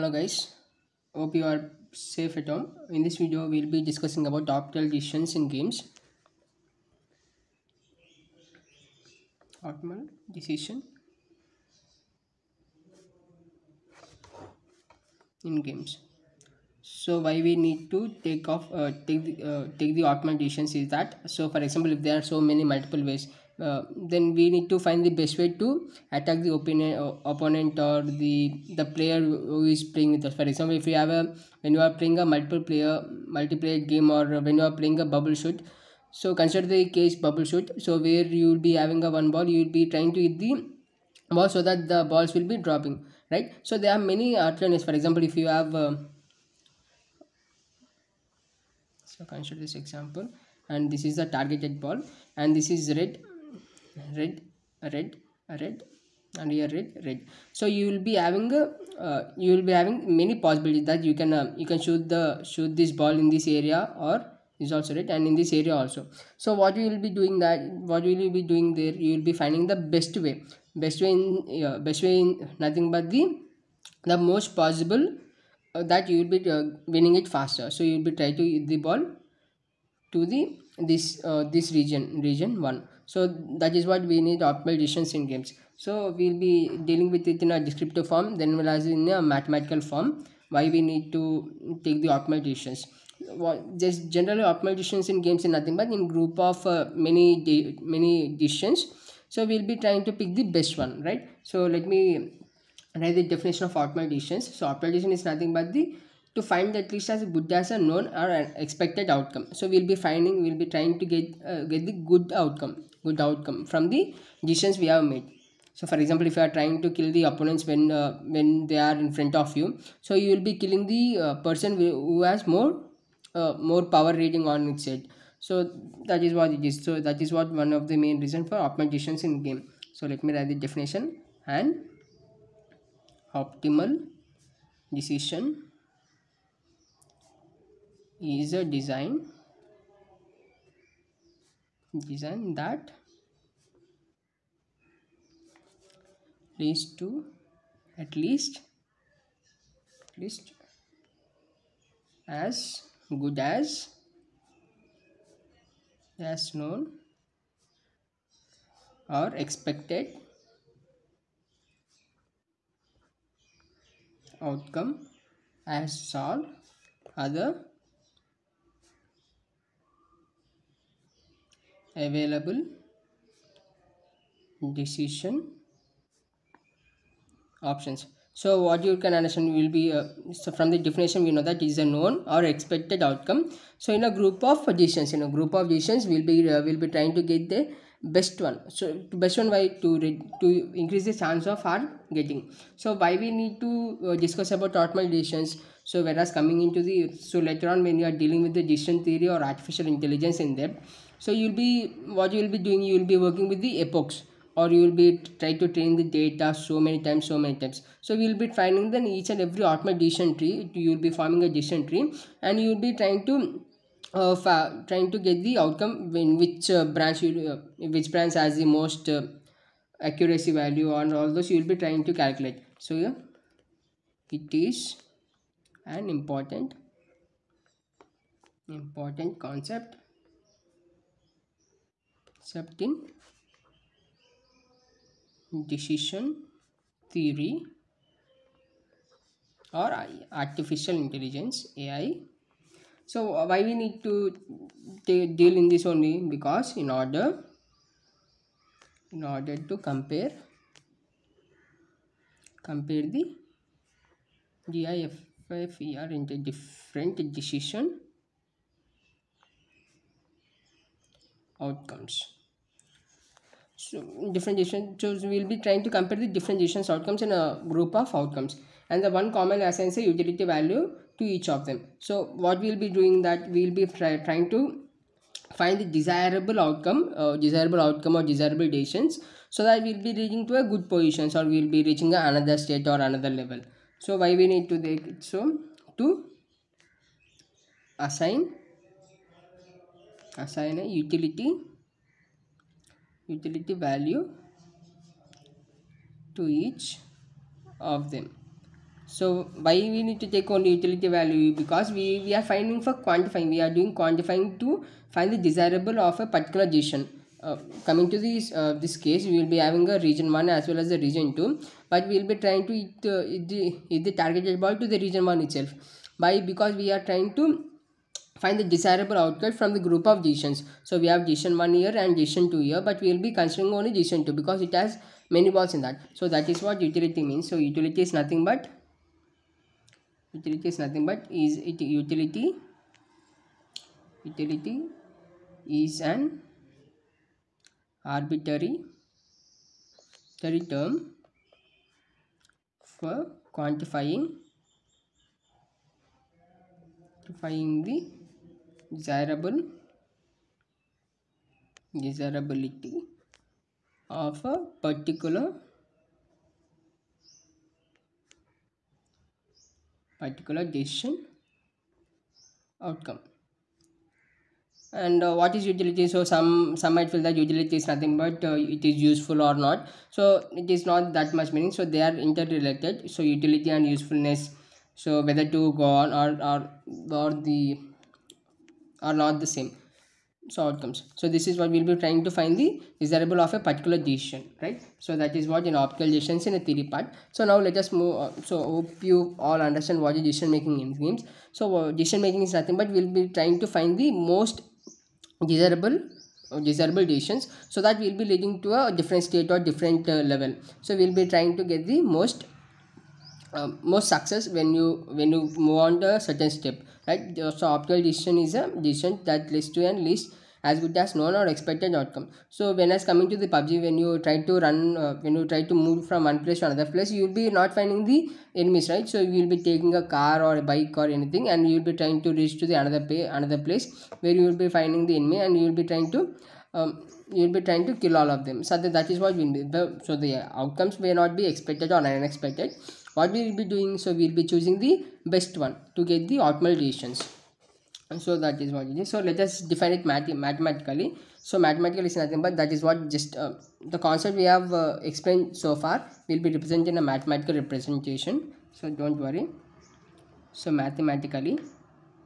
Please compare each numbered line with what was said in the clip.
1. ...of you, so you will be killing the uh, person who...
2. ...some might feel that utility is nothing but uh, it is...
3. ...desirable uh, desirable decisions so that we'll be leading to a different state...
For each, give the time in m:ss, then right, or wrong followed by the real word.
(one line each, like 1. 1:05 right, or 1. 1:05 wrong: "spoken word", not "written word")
1. 1:59 right
2. 6:06 right
3. 6:35 right.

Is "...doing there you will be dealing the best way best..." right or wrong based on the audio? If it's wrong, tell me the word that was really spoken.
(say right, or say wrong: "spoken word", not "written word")
wrong: "finding", not "dealing".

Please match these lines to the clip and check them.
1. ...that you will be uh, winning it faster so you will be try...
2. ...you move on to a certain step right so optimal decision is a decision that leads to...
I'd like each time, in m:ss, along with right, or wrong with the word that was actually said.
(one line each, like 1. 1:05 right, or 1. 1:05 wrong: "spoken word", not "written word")
1. 1:15 right
2. 6:45 right.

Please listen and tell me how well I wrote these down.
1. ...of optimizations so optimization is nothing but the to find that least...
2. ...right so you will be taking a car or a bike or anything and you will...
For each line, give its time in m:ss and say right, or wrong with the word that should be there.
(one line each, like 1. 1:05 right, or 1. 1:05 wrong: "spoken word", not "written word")
1. 1:43 right
2. 6:58 right.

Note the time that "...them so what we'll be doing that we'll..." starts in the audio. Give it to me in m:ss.
4:31.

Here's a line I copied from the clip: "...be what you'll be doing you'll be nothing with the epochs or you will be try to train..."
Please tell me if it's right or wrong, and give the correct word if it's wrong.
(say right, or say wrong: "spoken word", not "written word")
wrong: "working", not "nothing".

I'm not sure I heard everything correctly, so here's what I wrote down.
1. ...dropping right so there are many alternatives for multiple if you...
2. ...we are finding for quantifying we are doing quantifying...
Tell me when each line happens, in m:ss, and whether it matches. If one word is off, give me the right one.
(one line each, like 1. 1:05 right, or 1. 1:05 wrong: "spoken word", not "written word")
1. 0:42 wrong: "example", not "multiple"
2. 5:02 right.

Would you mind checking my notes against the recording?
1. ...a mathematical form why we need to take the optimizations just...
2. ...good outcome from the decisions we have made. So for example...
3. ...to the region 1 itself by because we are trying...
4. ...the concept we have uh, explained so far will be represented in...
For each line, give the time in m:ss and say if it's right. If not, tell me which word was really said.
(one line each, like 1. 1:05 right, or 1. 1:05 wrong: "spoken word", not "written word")
1. 1:29 right
2. 1:53 right
3. 5:14 right
4. 7:23 right.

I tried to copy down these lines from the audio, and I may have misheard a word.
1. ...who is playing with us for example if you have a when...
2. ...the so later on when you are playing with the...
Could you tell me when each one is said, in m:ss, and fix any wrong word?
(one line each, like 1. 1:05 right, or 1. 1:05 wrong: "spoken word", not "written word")
1. 0:29 right
2. 3:16 wrong: "dealing", not "playing".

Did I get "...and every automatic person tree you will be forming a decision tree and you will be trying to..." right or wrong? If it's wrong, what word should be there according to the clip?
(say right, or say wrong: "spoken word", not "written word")
wrong: "decision", not "person".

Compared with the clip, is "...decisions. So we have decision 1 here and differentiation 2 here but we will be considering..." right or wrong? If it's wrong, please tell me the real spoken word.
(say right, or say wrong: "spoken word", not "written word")
wrong: "decision", not "differentiation".